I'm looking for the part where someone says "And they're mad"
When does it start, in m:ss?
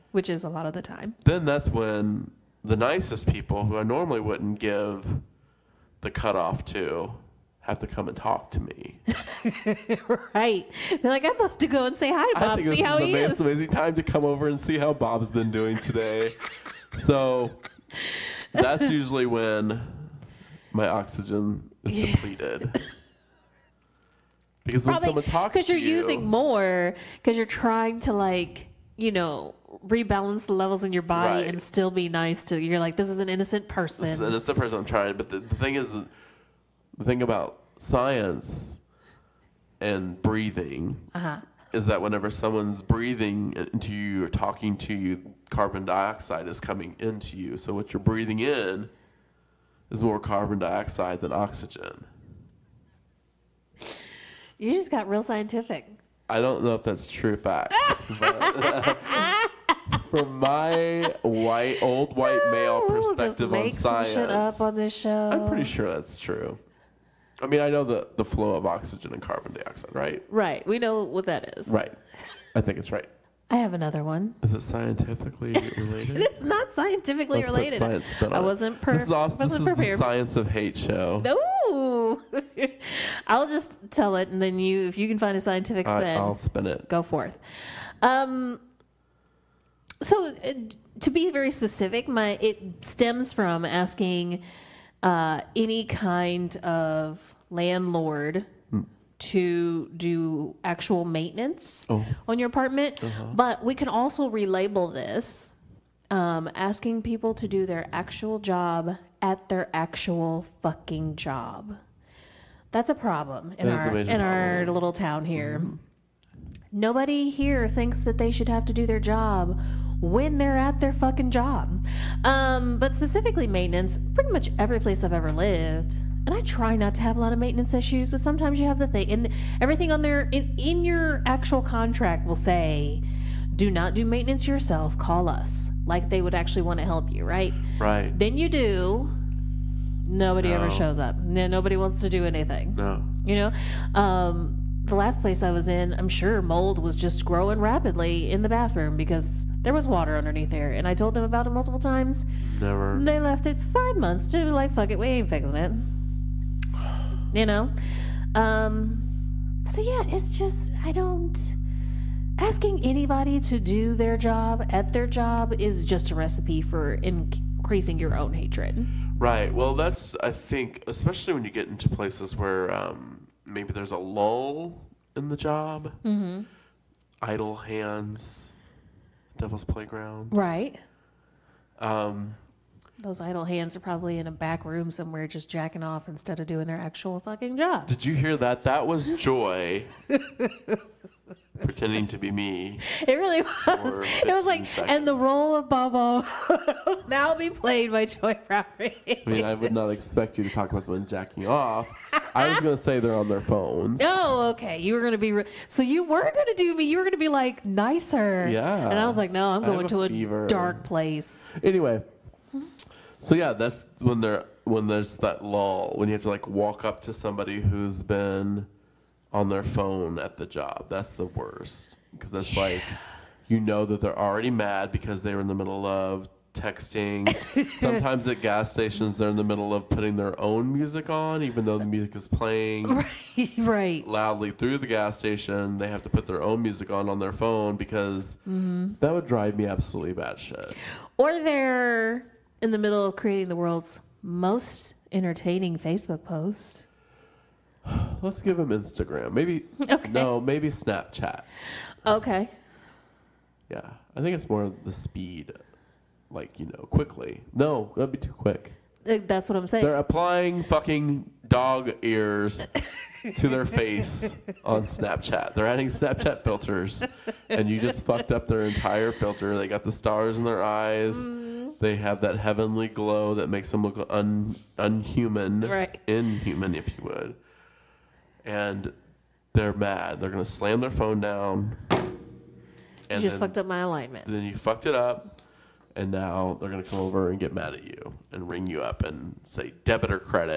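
4:38.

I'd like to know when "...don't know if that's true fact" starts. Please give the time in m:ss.
0:56.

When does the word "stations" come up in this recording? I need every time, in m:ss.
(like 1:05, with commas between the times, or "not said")
3:48, 3:55.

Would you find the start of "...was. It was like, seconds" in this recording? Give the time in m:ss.
3:13.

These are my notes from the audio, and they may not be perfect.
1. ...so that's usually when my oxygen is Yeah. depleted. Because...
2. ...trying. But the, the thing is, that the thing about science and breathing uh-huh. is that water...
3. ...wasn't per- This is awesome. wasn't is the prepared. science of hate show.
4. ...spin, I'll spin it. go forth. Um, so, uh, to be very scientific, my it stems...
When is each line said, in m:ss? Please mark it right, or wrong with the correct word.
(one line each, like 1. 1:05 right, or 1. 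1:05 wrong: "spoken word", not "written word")
1. 0:17 right
2. 0:34 wrong: "whenever", not "water"
3. 1:18 right
4. 1:26 wrong: "specific", not "scientific".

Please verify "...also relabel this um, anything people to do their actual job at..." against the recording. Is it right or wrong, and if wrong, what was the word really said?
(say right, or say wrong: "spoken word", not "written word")
wrong: "asking", not "anything".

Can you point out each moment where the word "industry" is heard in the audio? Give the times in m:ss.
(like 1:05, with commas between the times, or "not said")
not said.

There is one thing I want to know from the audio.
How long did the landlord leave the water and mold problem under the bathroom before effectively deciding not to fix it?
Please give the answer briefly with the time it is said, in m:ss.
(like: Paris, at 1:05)
5 months, at 2:33.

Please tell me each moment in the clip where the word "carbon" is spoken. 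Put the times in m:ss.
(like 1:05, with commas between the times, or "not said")
0:45, 0:50, 1:09.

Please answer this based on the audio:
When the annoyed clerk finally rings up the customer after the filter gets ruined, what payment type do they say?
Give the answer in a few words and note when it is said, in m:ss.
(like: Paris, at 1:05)
debit, at 4:49.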